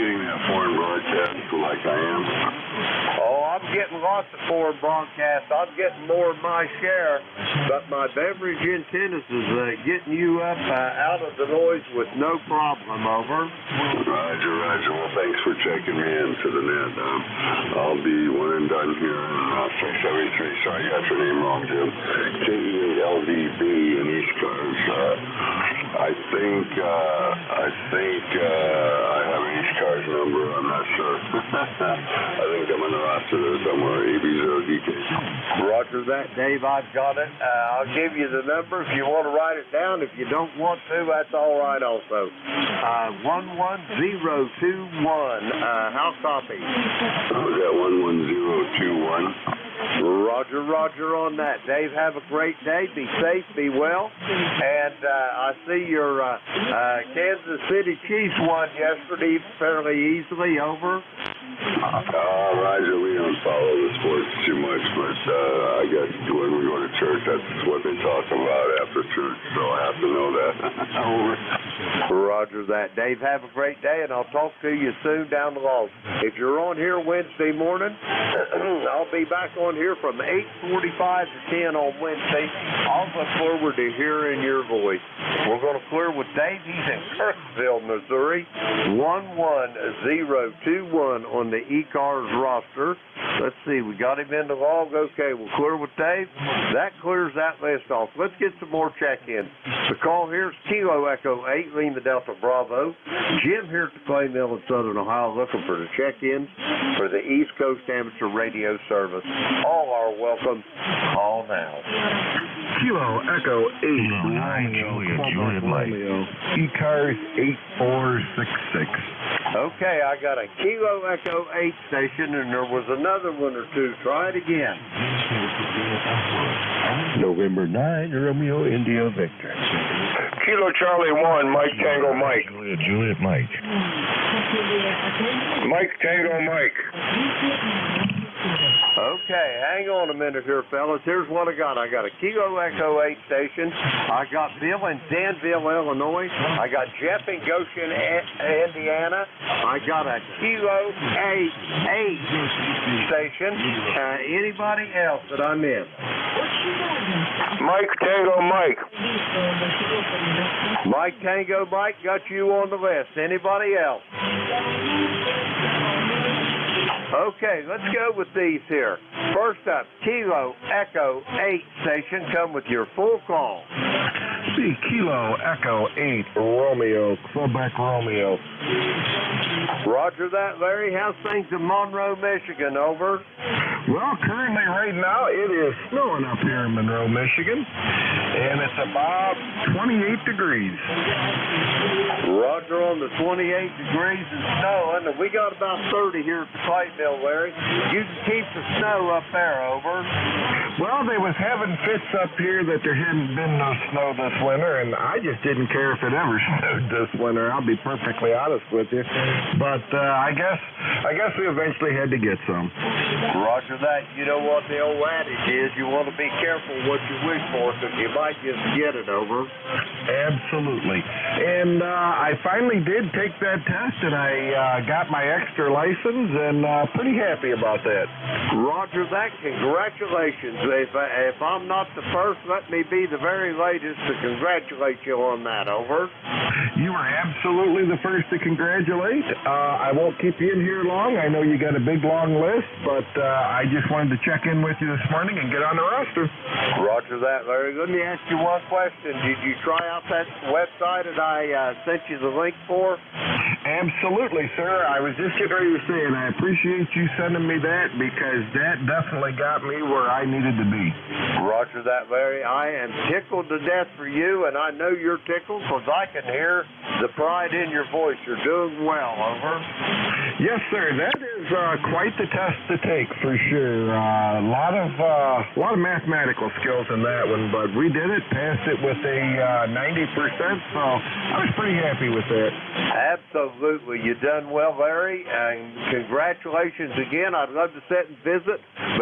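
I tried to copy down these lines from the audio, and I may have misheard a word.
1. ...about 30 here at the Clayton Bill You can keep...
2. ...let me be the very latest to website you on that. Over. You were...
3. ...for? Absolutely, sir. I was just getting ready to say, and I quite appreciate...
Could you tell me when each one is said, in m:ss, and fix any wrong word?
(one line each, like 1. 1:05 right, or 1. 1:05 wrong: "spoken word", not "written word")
1. 3:15 right
2. 3:52 wrong: "congratulate", not "website"
3. 4:12 wrong: "appreciate", not "quite".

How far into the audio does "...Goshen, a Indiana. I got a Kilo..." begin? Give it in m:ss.
2:27.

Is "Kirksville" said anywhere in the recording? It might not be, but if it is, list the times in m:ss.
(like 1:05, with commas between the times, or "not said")
1:27.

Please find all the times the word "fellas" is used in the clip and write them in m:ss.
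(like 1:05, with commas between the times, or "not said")
2:20.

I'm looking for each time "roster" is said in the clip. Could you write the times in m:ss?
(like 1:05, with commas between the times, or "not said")
0:33, 1:32, 4:05.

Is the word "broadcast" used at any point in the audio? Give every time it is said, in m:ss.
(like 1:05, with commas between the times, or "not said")
0:00, 0:04.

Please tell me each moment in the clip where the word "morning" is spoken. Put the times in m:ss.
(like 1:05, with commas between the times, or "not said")
1:17, 4:05.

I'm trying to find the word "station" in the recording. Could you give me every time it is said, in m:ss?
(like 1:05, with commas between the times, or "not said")
2:01, 2:23, 2:33, 2:51.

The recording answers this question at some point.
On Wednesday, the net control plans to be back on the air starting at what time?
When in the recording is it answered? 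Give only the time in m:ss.
1:20.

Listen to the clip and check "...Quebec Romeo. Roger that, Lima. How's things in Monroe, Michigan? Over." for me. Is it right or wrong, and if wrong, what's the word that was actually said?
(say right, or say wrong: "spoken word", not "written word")
wrong: "Larry", not "Lima".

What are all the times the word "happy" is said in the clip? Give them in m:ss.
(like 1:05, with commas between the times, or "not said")
3:47, 4:41.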